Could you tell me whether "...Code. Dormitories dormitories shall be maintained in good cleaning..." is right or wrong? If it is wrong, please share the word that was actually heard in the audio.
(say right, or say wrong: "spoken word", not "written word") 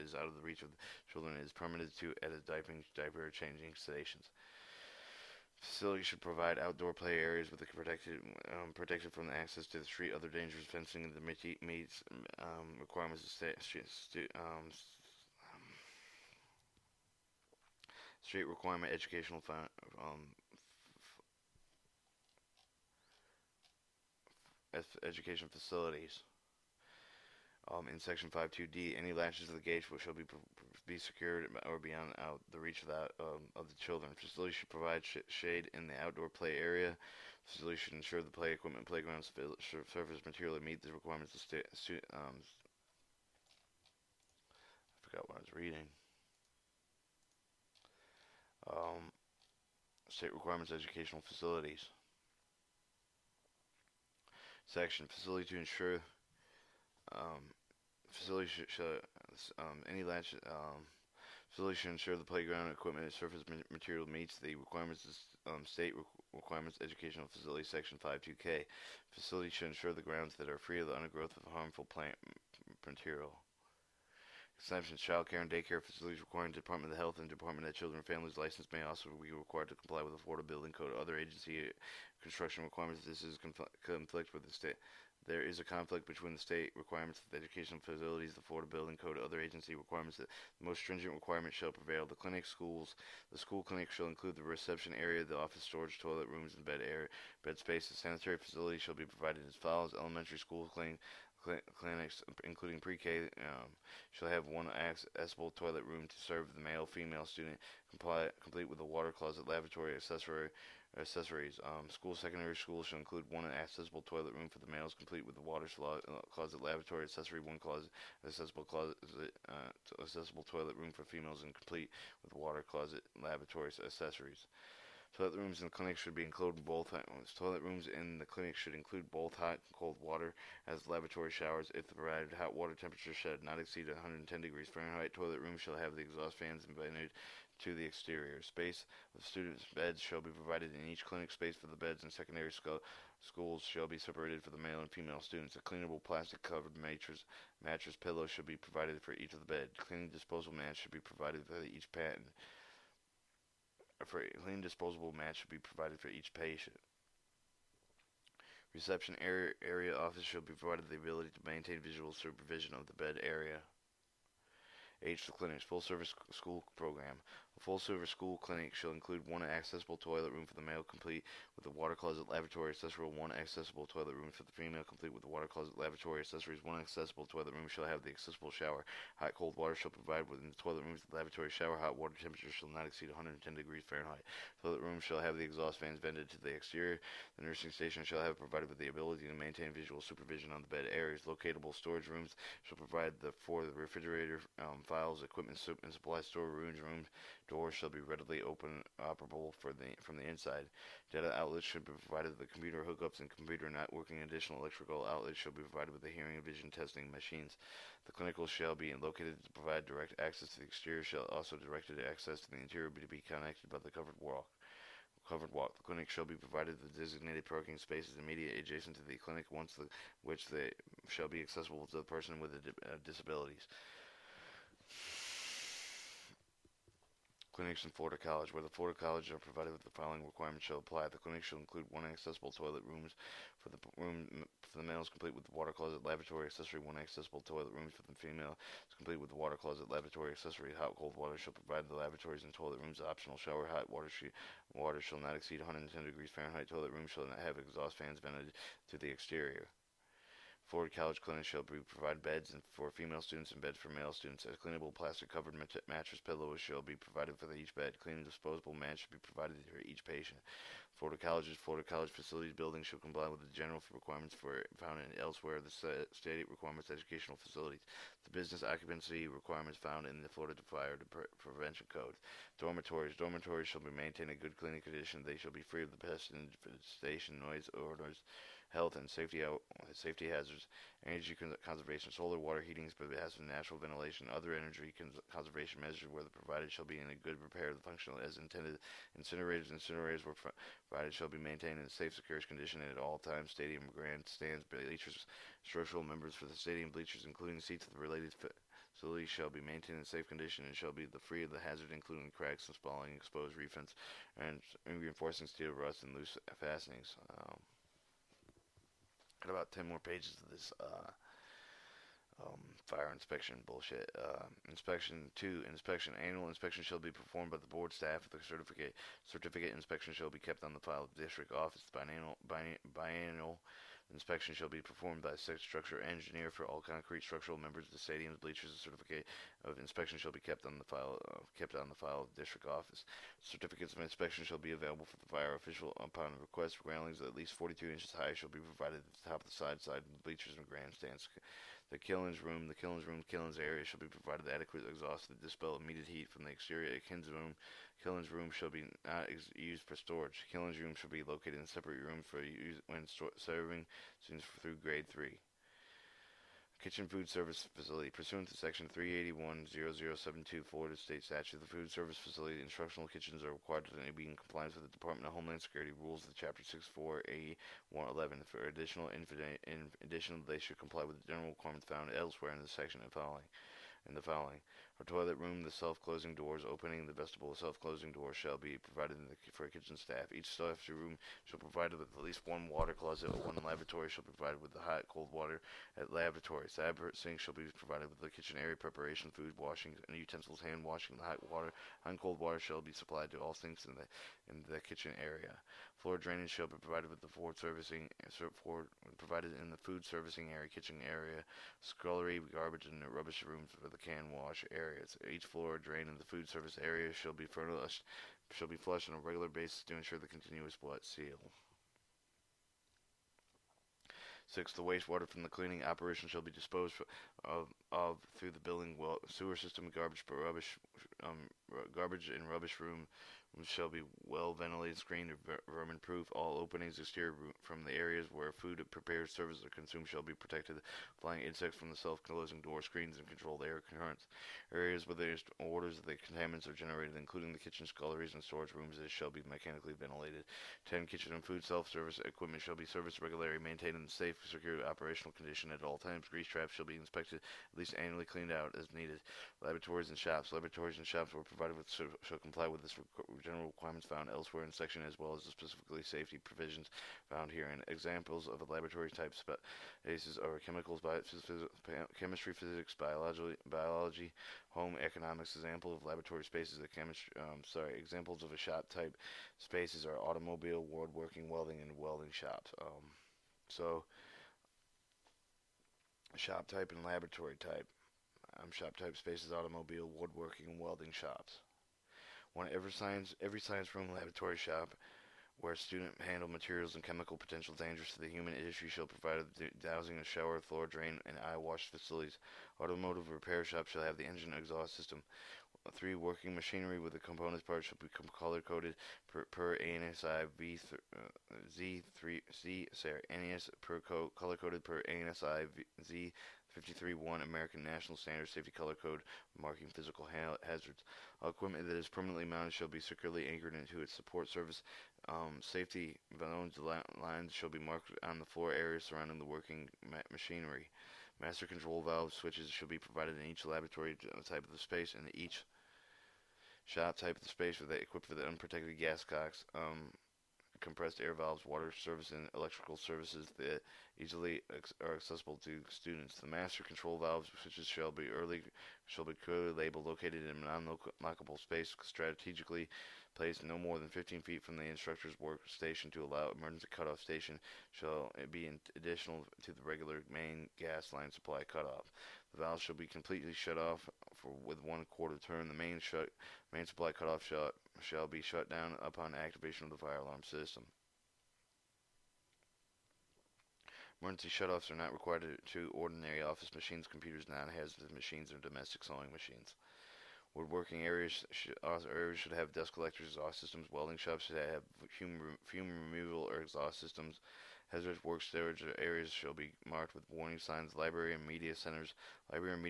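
right.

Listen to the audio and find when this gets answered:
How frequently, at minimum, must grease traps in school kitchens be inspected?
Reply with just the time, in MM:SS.
07:28.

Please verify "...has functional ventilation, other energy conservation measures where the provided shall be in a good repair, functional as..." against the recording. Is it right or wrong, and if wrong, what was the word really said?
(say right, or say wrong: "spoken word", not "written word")
wrong: "natural", not "functional".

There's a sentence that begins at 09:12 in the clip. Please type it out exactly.
The valves shall be completely shut off for, with one quarter turn.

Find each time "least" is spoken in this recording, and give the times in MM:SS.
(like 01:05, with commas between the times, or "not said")
05:37, 06:22, 07:27.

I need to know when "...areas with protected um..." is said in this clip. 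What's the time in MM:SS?
00:07.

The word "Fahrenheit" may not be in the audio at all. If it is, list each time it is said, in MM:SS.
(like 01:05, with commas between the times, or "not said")
02:14, 03:03, 04:06.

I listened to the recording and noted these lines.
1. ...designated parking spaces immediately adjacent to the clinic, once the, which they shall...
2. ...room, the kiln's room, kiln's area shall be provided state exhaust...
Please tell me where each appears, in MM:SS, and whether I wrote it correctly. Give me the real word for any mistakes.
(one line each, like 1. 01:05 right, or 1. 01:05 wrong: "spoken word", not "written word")
1. 03:36 right
2. 05:42 wrong: "adequate", not "state".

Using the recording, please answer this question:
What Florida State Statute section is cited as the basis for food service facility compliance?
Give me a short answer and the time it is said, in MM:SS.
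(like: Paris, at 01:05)
Section 381, at 05:58.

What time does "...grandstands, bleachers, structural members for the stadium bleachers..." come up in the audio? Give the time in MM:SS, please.
04:53.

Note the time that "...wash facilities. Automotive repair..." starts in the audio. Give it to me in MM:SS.
08:11.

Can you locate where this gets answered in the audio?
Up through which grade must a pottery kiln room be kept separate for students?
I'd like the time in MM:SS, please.
05:54.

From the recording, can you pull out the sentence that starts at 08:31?
All equipment that is permanently mounted shall be securely anchored into its support service.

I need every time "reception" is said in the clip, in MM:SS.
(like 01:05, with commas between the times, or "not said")
01:34, 02:38.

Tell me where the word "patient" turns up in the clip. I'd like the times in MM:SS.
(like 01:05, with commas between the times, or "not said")
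02:31, 02:36, 04:20.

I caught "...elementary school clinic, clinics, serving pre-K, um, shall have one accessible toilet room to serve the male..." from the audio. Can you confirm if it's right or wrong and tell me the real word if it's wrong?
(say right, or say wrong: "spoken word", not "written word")
wrong: "including", not "serving".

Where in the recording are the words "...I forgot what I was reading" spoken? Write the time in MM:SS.
00:44.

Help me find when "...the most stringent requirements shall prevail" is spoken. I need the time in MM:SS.
01:30.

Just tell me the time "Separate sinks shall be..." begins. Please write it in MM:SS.
06:26.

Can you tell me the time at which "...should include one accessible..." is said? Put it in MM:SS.
01:52.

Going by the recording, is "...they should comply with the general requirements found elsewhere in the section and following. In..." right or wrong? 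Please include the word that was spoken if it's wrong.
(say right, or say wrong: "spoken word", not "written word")
right.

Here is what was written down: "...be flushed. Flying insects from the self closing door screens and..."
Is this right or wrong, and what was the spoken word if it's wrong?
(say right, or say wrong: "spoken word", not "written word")
wrong: "protected", not "flushed".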